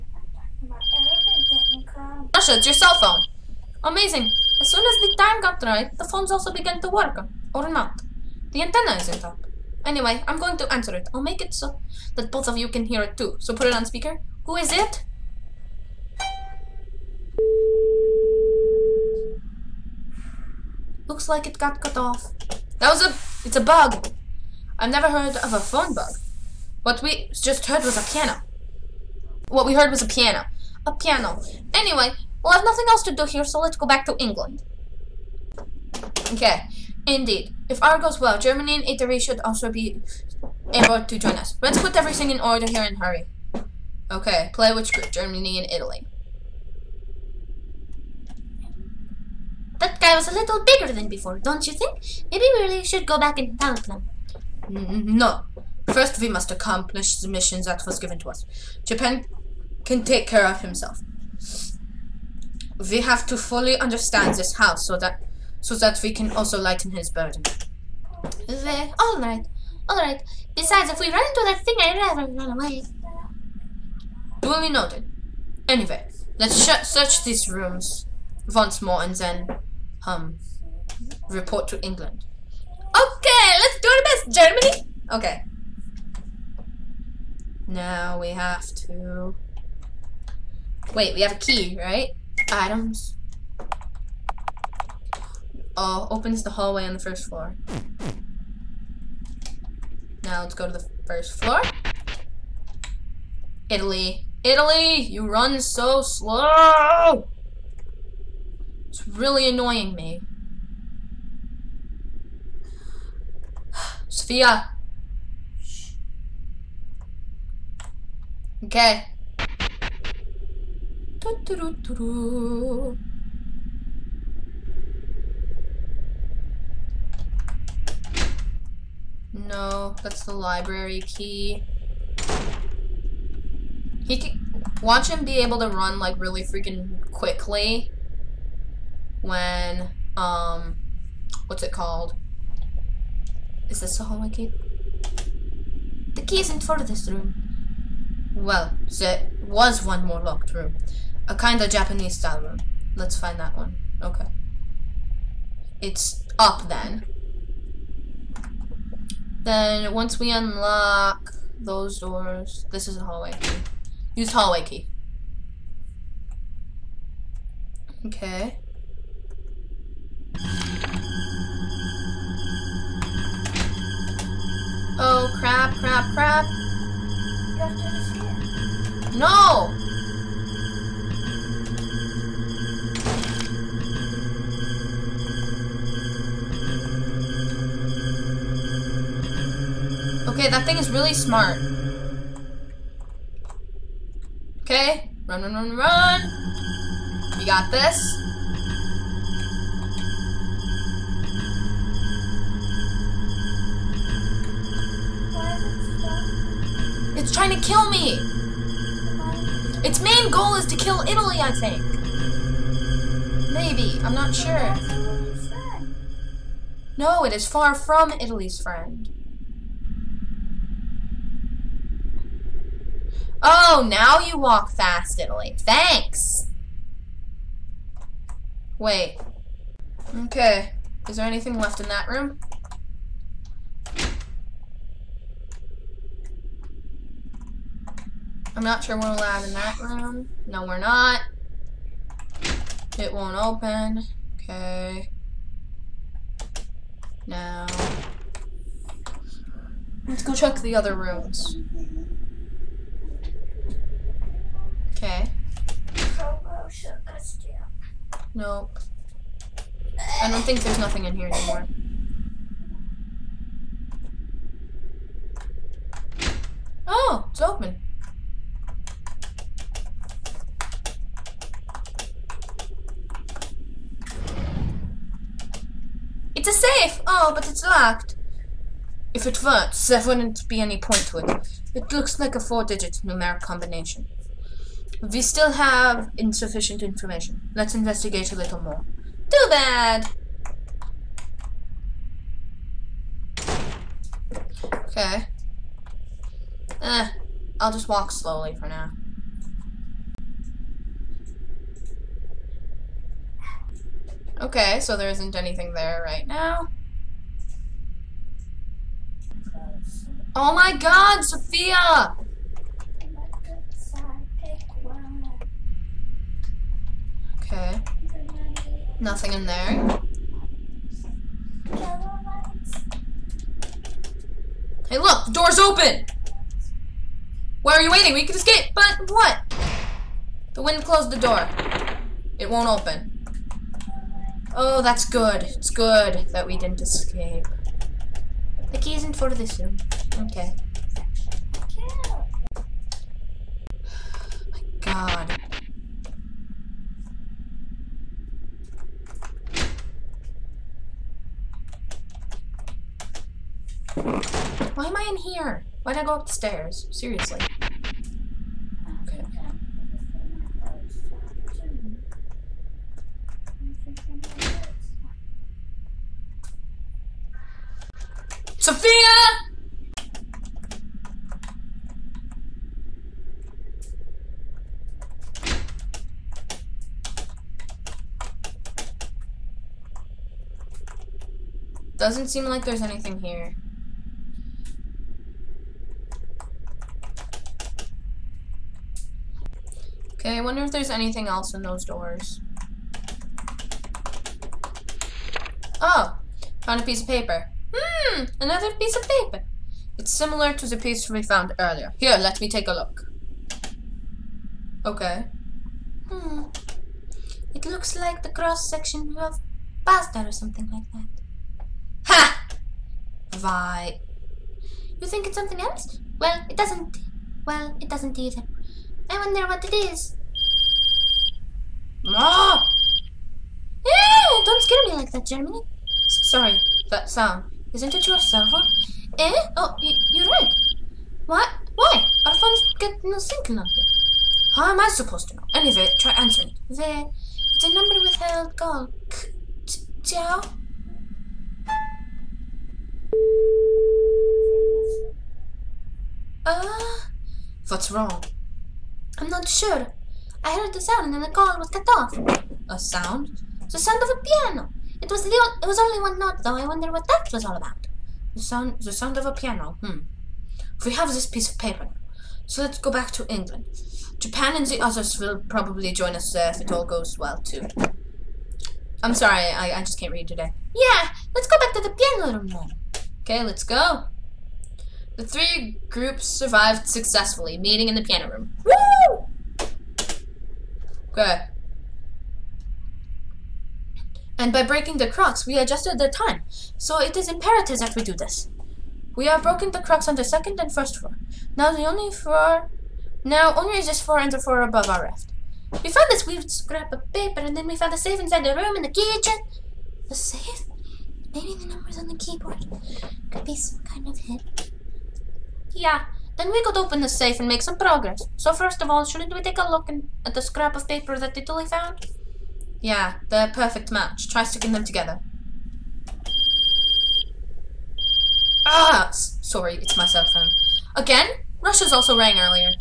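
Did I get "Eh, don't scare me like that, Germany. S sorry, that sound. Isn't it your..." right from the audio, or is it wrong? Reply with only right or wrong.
right.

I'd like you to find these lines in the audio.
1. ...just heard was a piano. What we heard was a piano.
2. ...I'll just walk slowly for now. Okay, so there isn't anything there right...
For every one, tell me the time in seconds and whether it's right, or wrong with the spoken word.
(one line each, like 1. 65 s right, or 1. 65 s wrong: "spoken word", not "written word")
1. 27 s right
2. 297 s right.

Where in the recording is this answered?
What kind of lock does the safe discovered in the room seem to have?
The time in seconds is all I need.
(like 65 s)
282 s.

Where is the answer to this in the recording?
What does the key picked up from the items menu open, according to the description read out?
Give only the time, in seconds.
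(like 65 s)
96 s.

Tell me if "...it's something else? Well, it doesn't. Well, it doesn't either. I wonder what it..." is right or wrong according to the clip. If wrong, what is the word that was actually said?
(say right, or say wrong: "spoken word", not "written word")
right.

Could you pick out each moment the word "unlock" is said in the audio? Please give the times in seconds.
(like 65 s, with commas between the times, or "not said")
160 s.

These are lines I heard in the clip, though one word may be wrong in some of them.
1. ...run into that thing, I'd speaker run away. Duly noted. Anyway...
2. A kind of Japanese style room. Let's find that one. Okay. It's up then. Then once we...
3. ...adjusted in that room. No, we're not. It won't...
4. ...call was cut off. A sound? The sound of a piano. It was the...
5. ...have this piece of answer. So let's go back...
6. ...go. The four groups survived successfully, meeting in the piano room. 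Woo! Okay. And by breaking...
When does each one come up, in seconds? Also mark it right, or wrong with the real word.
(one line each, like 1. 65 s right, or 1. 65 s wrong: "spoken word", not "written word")
1. 71 s wrong: "rather", not "speaker"
2. 151 s right
3. 239 s wrong: "allowed", not "adjusted"
4. 451 s right
5. 460 s wrong: "paper", not "answer"
6. 473 s wrong: "three", not "four".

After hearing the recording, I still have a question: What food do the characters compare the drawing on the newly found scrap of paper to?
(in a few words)
pasta.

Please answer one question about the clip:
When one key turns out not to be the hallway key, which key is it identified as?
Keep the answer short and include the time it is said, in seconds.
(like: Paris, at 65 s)
library key, at 130 s.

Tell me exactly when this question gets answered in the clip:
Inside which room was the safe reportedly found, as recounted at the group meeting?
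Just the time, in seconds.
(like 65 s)
498 s.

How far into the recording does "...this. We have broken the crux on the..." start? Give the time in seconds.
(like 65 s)
488 s.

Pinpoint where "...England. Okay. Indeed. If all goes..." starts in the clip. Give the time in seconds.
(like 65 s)
34 s.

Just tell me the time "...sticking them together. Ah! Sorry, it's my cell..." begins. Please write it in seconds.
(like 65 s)
514 s.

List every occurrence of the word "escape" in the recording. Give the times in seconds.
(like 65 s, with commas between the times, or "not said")
328 s, 336 s.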